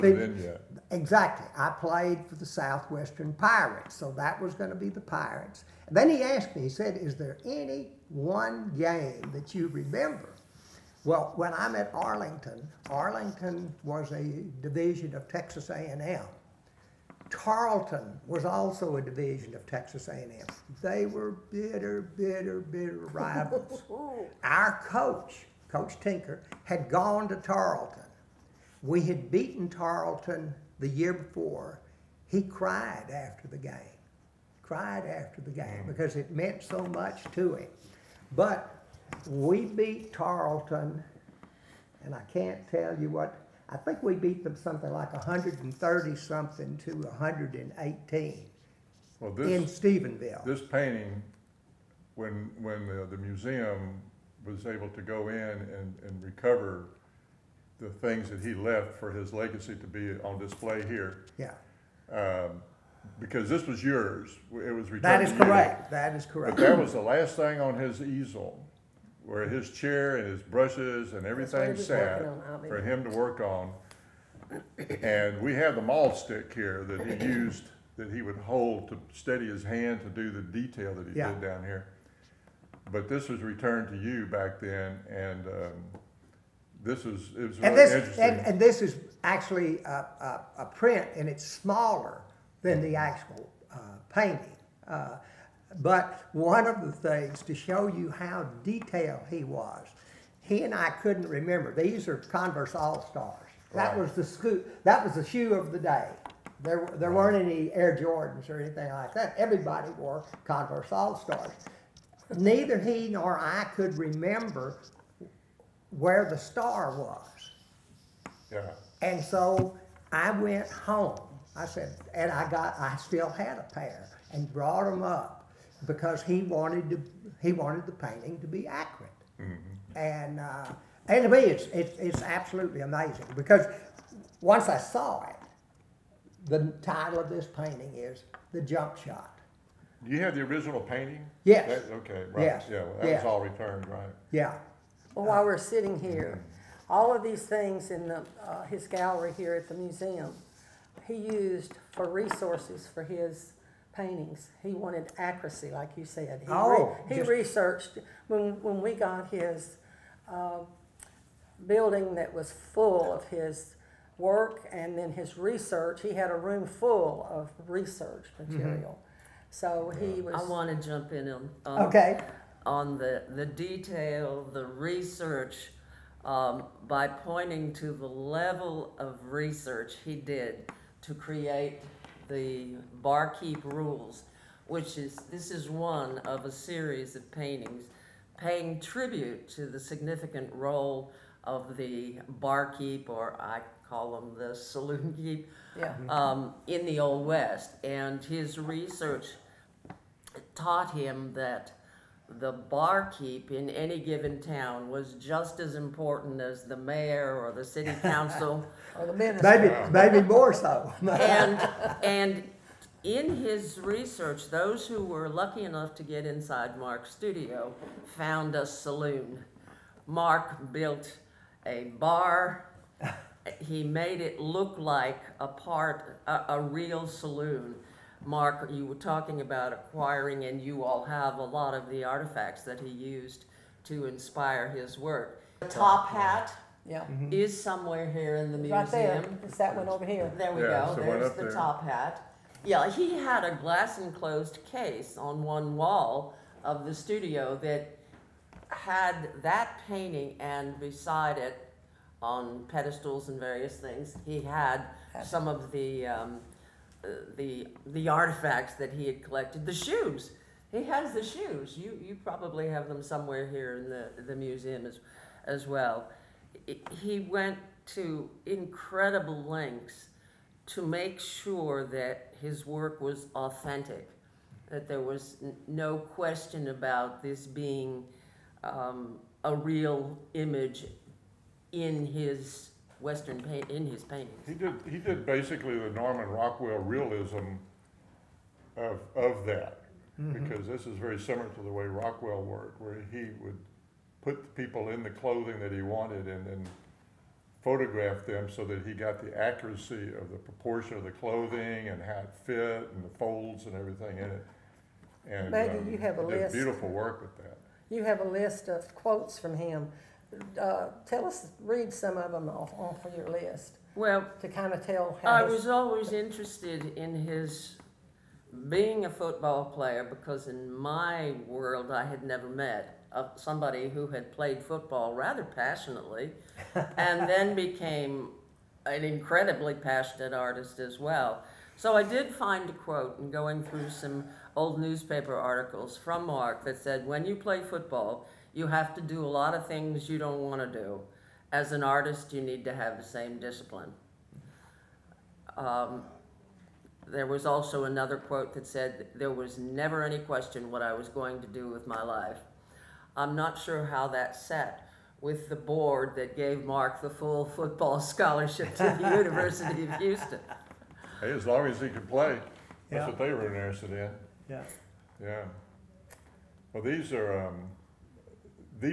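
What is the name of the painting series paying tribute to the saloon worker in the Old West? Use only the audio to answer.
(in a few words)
Barkeep Rules.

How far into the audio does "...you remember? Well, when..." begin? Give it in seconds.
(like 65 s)
9 s.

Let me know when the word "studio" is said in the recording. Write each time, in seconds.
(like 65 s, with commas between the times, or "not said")
217 s, 246 s.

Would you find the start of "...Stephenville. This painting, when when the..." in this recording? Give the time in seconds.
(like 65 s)
49 s.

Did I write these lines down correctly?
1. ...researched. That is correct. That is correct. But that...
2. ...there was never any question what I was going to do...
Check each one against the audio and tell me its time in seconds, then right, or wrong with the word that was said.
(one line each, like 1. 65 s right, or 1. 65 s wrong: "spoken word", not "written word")
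1. 64 s wrong: "returned", not "researched"
2. 349 s right.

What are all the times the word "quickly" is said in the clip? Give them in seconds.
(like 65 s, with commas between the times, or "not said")
not said.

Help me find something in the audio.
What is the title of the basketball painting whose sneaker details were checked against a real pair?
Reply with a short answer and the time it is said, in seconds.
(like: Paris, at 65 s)
The Jump Shot, at 138 s.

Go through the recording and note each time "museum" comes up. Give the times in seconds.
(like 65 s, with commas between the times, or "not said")
53 s, 149 s, 238 s, 264 s.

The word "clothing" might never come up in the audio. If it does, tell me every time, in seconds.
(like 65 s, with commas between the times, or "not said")
295 s, 301 s.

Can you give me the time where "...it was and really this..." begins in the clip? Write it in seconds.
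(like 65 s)
87 s.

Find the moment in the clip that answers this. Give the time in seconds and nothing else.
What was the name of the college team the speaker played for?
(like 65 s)
2 s.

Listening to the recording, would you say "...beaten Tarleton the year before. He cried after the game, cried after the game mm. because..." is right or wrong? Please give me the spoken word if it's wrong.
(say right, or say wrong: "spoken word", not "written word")
right.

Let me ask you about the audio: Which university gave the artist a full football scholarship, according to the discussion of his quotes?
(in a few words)
University of Houston.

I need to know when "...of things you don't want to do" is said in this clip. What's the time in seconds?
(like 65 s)
339 s.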